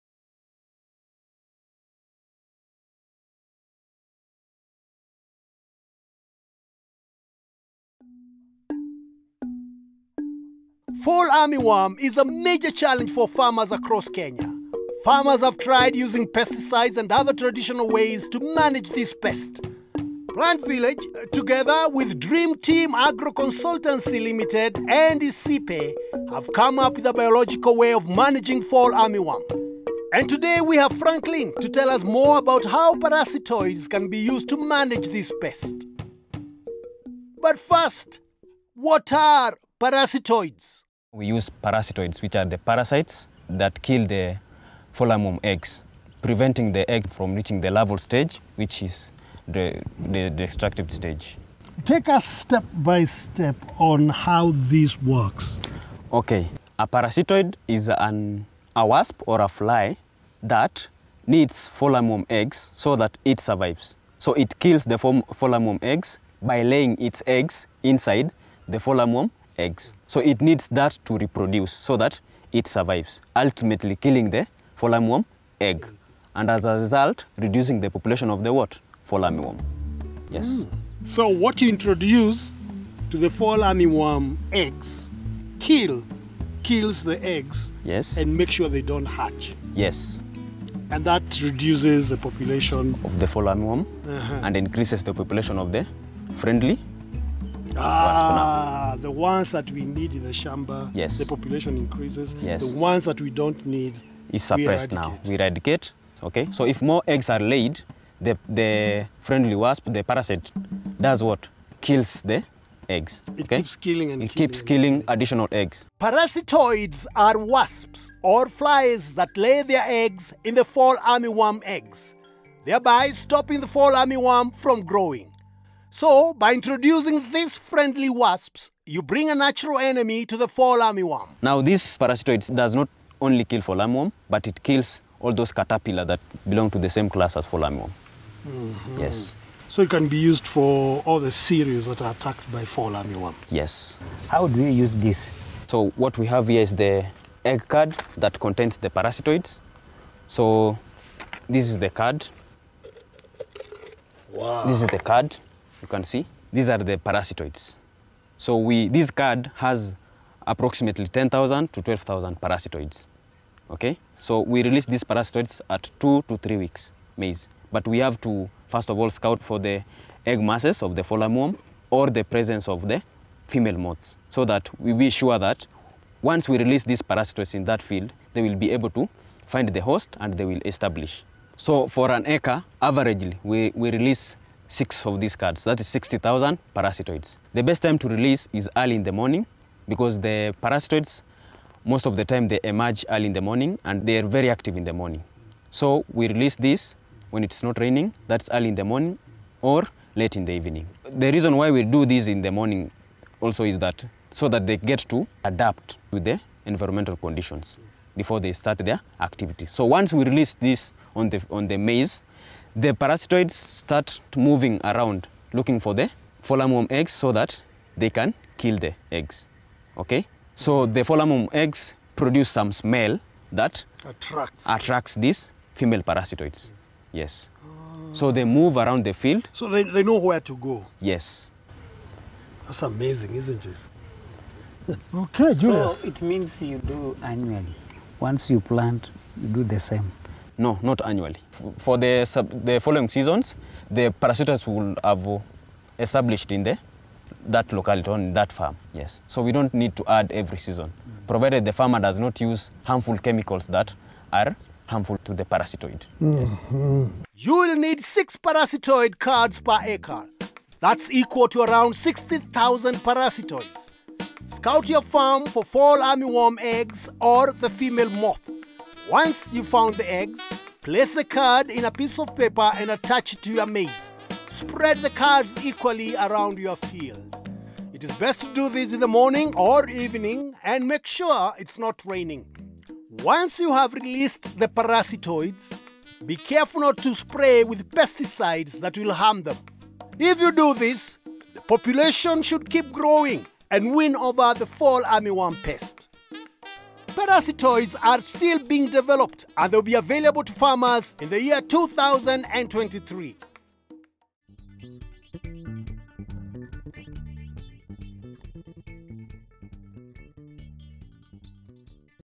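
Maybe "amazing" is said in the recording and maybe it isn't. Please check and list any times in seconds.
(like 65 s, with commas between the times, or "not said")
232 s.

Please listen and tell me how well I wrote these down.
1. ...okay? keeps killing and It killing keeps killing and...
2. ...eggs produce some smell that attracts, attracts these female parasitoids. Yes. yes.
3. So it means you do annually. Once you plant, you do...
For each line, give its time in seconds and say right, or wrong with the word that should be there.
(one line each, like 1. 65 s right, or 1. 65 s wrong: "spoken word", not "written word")
1. 113 s right
2. 221 s right
3. 235 s right.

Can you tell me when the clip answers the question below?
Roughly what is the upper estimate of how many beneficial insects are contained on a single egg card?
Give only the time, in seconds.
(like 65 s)
161 s.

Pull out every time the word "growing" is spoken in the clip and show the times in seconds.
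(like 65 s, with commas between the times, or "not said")
124 s, 292 s.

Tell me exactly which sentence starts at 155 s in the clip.
You can see these are the parasitoids.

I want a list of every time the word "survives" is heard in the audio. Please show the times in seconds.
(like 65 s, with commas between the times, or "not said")
63 s, 72 s.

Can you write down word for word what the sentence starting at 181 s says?
So for an acre, averagely, we, we release six of these cards.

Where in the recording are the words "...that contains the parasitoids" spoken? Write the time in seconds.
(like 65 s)
148 s.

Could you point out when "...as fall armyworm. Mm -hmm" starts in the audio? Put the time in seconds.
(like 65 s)
137 s.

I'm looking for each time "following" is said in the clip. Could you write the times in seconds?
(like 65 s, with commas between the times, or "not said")
242 s.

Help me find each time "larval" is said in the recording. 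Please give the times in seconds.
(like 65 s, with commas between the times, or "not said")
47 s.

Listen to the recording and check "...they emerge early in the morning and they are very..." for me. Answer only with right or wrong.
right.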